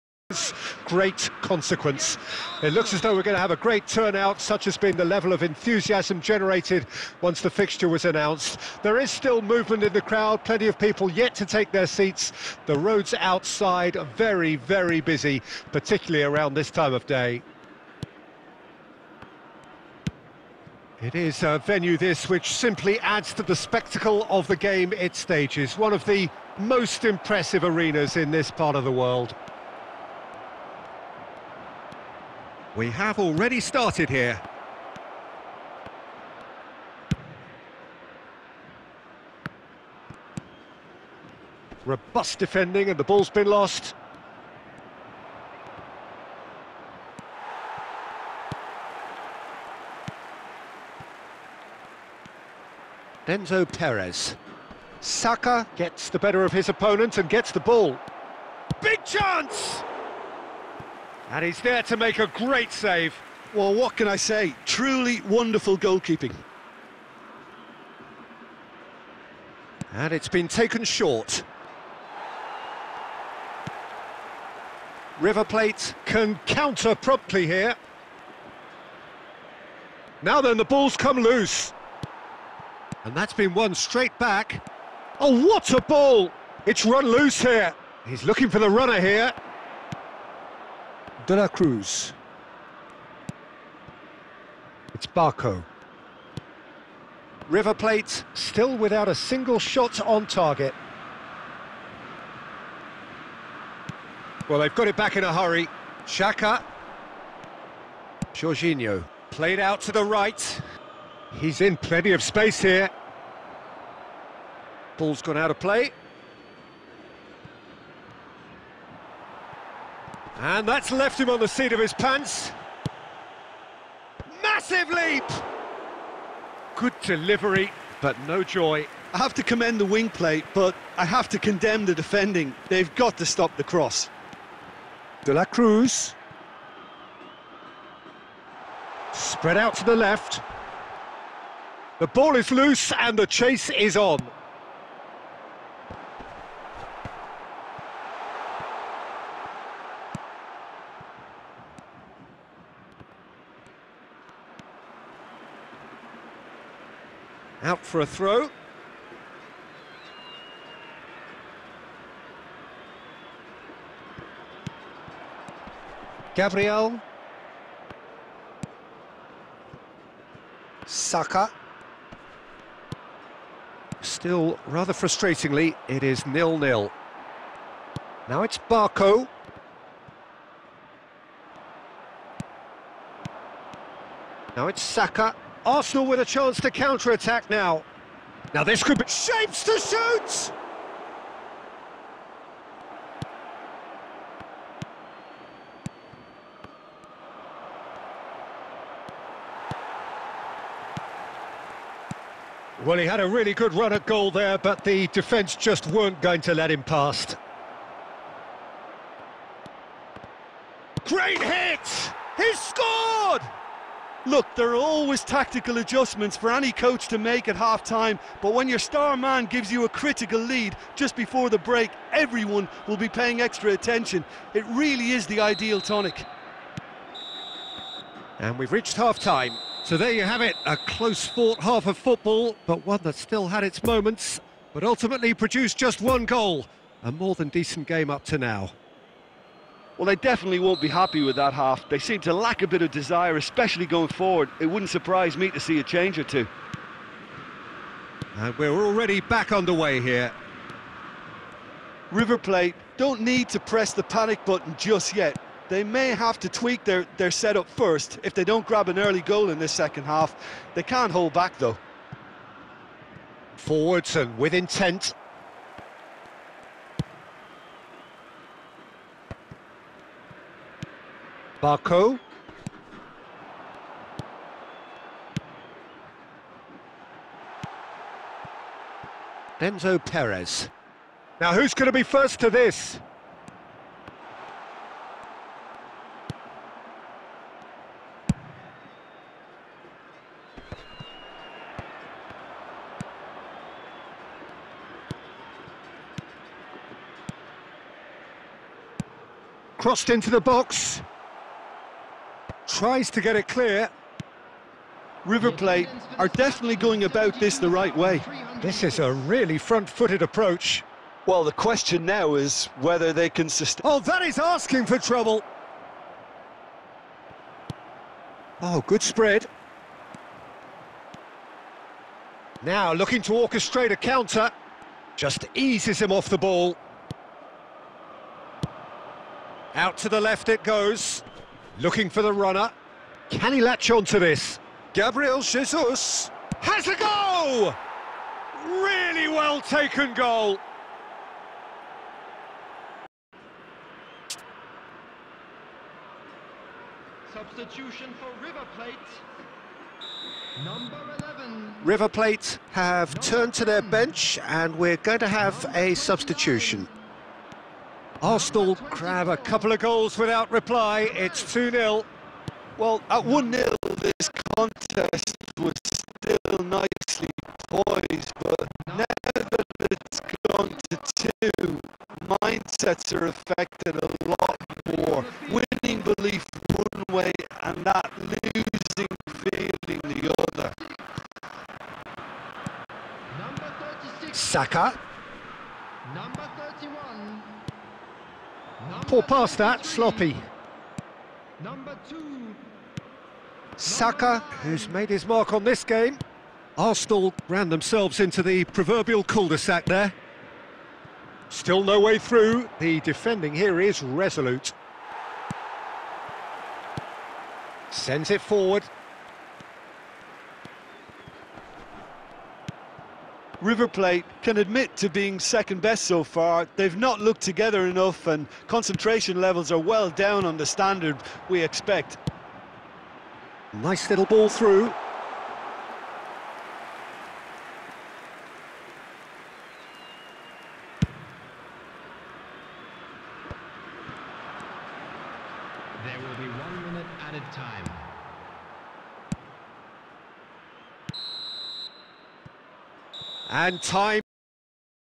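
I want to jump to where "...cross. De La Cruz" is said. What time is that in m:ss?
2:13.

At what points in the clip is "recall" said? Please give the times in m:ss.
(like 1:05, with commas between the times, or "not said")
not said.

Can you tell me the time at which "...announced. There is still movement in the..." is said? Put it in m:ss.
0:08.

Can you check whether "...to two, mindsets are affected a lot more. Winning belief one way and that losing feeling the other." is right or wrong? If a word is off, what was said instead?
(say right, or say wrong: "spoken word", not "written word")
right.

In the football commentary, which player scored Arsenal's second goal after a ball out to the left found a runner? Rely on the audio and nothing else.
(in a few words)
Gabriel Jesus.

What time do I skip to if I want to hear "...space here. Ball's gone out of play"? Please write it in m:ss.
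1:52.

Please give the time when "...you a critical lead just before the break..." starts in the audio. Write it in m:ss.
3:39.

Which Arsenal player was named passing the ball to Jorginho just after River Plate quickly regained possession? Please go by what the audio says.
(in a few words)
Xhaka.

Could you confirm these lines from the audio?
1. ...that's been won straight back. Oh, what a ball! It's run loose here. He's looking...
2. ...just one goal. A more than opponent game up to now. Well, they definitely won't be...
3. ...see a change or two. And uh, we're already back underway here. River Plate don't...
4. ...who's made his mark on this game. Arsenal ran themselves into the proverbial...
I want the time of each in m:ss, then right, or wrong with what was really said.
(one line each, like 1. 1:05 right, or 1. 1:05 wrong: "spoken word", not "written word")
1. 1:23 right
2. 3:55 wrong: "decent", not "opponent"
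3. 4:05 right
4. 6:34 right.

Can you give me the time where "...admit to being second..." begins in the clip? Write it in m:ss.
6:54.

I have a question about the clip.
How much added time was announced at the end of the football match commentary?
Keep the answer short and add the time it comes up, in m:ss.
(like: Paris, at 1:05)
1 minute, at 7:16.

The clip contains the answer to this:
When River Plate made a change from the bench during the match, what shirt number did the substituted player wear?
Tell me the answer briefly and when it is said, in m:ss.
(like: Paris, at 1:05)
11, at 5:50.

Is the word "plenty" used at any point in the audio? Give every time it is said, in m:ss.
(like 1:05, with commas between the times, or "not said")
0:10, 1:51.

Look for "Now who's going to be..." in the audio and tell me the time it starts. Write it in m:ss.
4:41.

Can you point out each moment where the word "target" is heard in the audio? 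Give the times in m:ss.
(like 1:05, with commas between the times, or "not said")
1:40.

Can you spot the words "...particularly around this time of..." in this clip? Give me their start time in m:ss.
0:15.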